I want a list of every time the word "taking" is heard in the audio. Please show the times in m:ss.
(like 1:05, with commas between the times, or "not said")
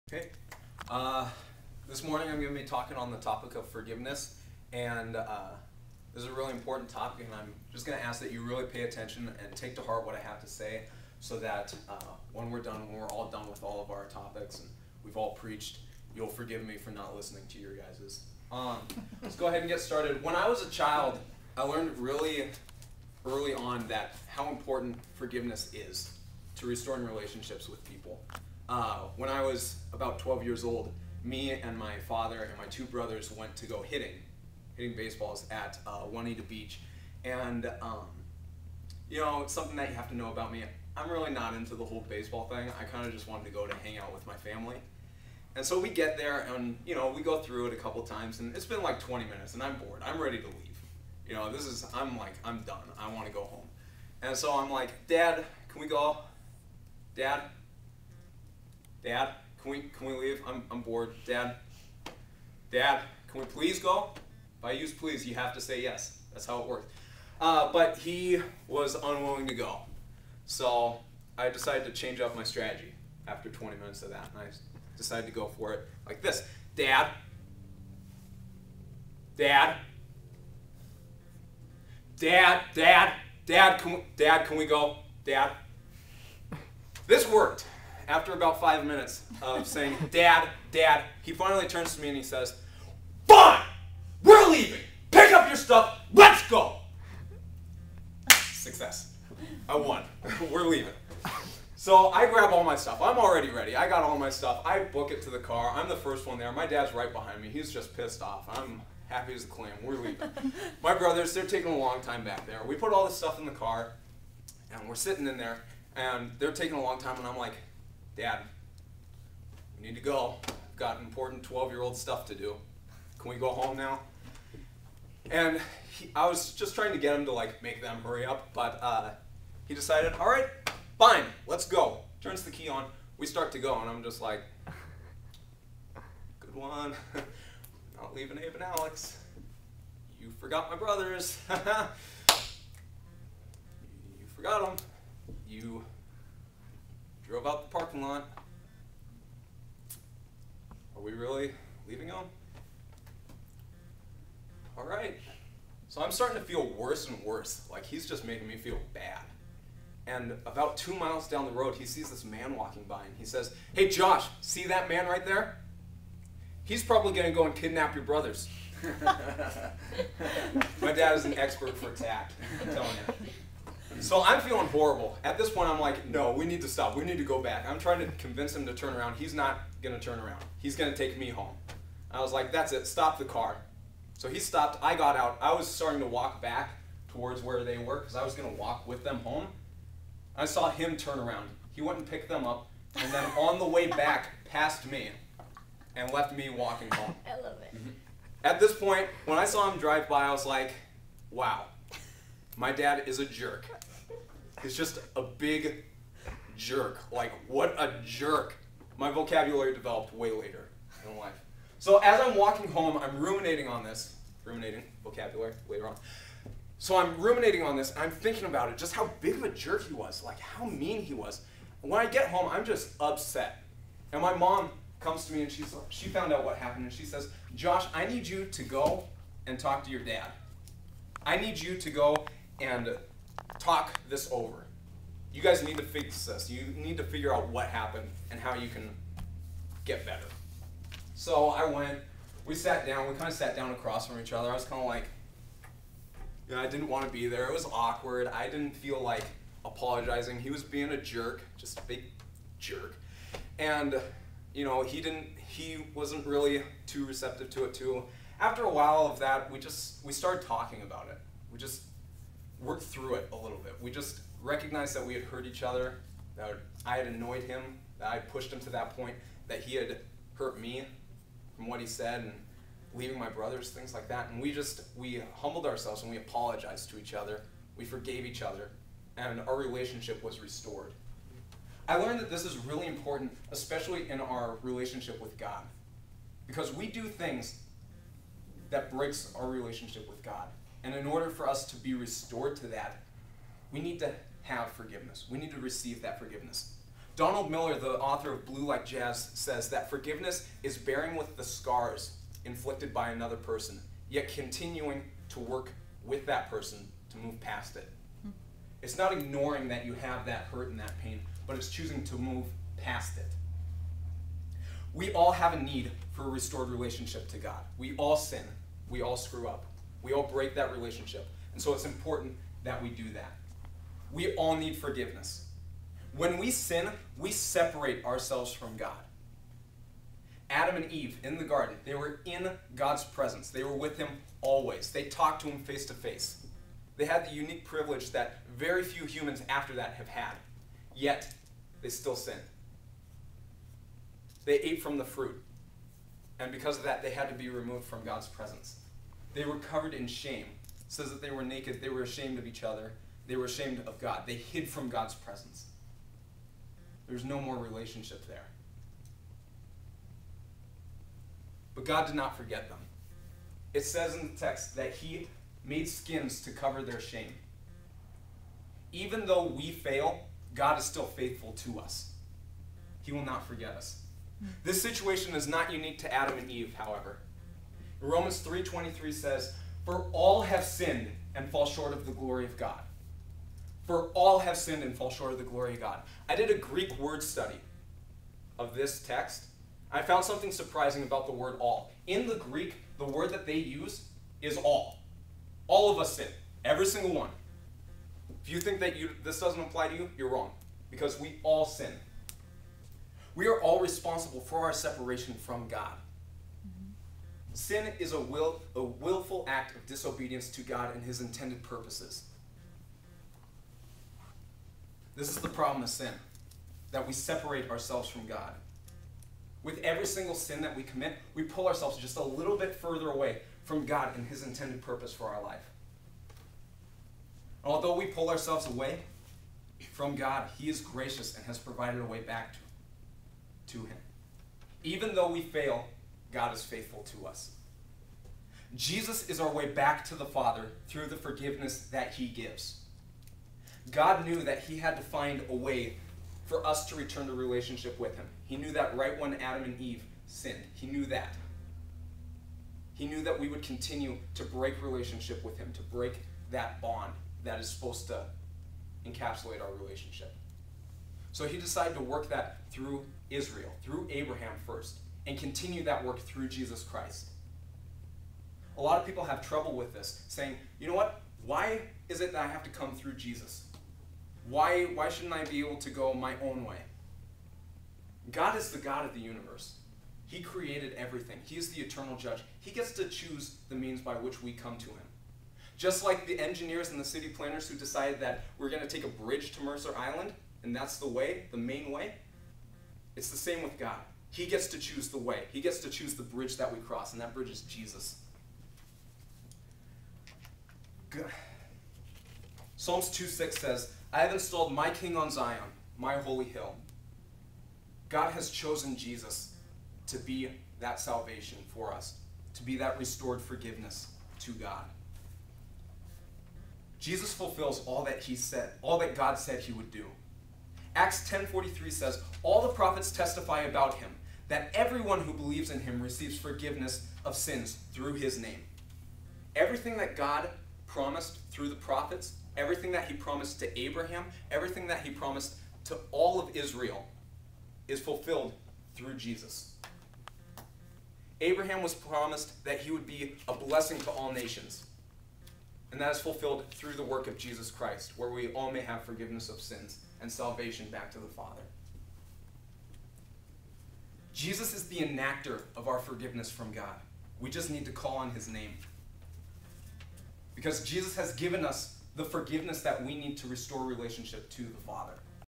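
1:51, 1:56.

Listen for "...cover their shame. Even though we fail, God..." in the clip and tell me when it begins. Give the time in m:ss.
6:06.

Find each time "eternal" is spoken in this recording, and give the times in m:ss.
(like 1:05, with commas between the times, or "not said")
8:01.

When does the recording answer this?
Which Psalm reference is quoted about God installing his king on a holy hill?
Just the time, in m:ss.
8:22.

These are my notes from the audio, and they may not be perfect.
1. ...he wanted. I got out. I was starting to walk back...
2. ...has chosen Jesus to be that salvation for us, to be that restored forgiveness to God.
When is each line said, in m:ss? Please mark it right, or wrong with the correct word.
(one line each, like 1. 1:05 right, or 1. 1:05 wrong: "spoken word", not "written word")
1. 3:04 wrong: "stopped", not "wanted"
2. 8:28 right.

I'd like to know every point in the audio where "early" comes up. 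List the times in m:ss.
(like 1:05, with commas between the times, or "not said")
0:23.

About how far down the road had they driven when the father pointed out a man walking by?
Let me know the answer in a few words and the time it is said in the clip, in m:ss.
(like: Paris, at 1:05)
2 miles, at 2:40.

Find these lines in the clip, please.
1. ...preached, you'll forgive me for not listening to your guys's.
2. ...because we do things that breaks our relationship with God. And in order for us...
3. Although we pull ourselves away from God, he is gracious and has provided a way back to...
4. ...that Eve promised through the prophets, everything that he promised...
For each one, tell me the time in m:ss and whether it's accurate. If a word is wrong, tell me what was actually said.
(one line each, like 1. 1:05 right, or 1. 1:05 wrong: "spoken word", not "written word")
1. 0:15 right
2. 4:46 right
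3. 7:07 right
4. 8:49 wrong: "God", not "Eve".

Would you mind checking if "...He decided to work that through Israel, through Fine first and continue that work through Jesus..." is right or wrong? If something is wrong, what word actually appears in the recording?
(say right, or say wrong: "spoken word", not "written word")
wrong: "Abraham", not "Fine".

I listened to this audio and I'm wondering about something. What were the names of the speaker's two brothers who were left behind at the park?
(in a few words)
Abe and Alex.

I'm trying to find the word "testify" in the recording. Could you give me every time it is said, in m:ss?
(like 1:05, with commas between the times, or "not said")
8:43.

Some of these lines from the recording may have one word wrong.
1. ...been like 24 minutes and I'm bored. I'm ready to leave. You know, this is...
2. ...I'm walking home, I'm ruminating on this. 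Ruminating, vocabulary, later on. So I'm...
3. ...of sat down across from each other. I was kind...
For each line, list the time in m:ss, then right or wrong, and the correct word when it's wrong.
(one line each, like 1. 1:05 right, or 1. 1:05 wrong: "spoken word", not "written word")
1. 0:48 wrong: "20", not "24"
2. 3:32 right
3. 4:03 right.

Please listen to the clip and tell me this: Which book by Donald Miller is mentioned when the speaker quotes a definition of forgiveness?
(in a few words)
Blue Like Jazz.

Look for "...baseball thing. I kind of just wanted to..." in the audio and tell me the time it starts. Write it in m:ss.
0:42.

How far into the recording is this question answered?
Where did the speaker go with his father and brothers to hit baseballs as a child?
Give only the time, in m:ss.
0:36.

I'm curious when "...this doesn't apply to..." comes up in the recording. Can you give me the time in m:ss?
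6:39.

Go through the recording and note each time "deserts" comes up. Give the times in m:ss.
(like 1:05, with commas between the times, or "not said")
not said.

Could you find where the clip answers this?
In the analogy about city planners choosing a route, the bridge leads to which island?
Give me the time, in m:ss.
8:09.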